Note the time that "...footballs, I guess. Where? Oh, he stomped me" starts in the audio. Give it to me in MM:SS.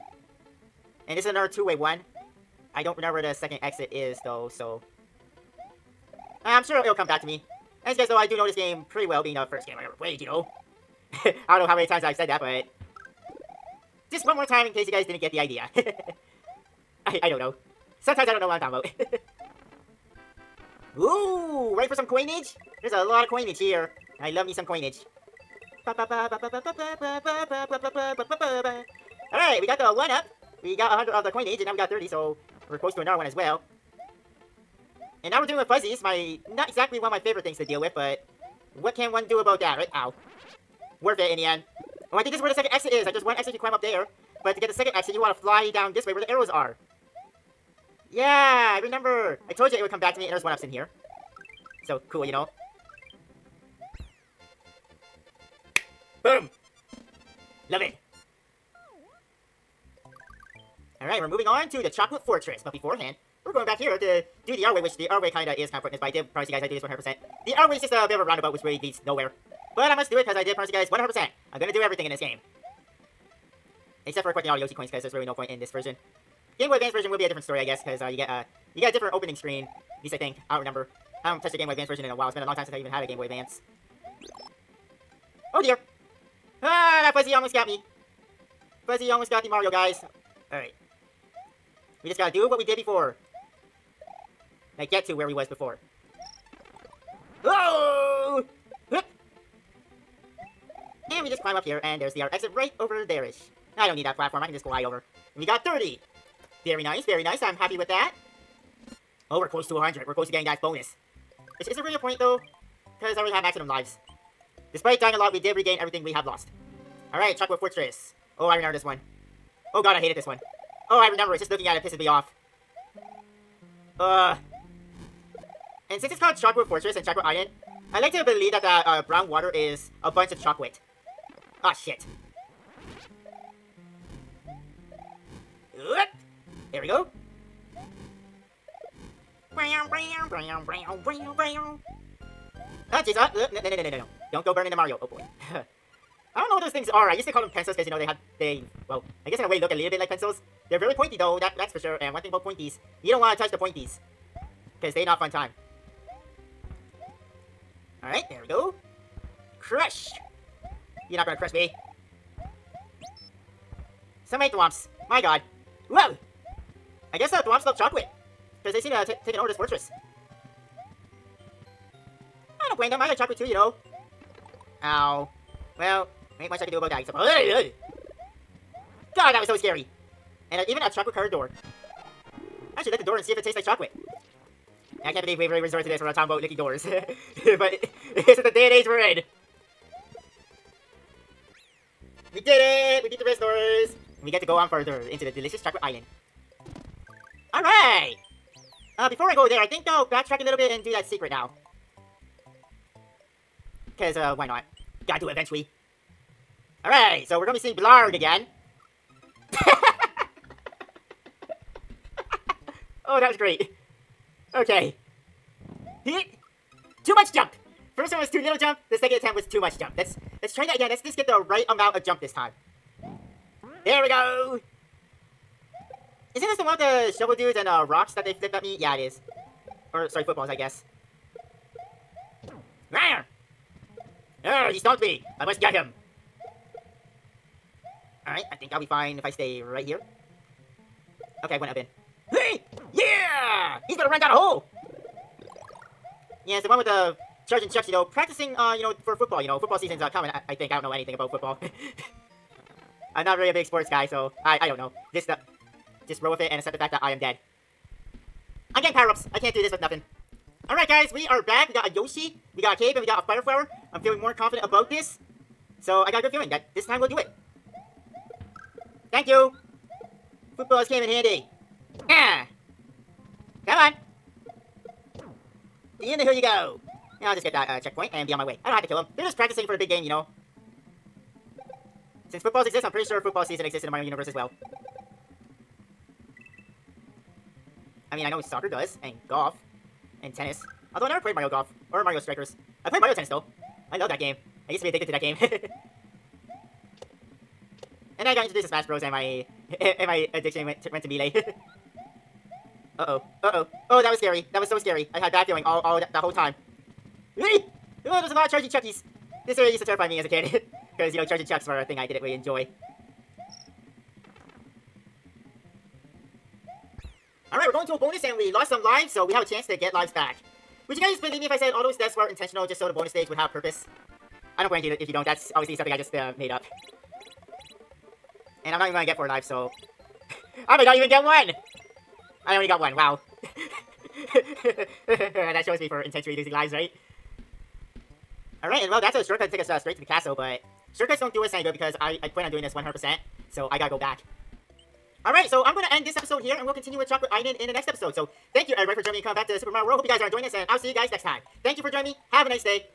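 03:50.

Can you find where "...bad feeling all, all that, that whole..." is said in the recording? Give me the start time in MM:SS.
05:05.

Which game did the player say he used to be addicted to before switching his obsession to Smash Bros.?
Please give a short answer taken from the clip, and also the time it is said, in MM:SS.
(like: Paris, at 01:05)
Mario Tennis, at 04:53.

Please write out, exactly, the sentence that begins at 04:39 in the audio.
They're just practicing for the big game, you know.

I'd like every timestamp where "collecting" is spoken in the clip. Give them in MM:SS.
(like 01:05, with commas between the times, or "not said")
01:14.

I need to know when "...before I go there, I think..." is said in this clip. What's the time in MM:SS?
03:19.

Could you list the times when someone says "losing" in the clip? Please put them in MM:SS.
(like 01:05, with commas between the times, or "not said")
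05:36.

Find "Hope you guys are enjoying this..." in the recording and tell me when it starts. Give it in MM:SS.
05:49.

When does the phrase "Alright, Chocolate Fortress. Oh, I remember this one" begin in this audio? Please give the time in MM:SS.
01:57.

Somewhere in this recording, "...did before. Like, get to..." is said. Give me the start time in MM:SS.
01:32.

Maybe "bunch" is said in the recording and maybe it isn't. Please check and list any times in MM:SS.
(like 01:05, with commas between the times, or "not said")
02:10.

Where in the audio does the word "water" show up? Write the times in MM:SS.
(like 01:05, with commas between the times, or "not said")
02:09.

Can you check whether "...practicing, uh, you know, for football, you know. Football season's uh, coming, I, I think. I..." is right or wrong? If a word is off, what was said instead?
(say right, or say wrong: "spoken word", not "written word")
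right.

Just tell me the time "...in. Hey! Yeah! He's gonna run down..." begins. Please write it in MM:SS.
04:01.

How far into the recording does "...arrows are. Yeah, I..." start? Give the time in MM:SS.
00:46.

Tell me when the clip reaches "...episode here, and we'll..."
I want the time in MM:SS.
05:46.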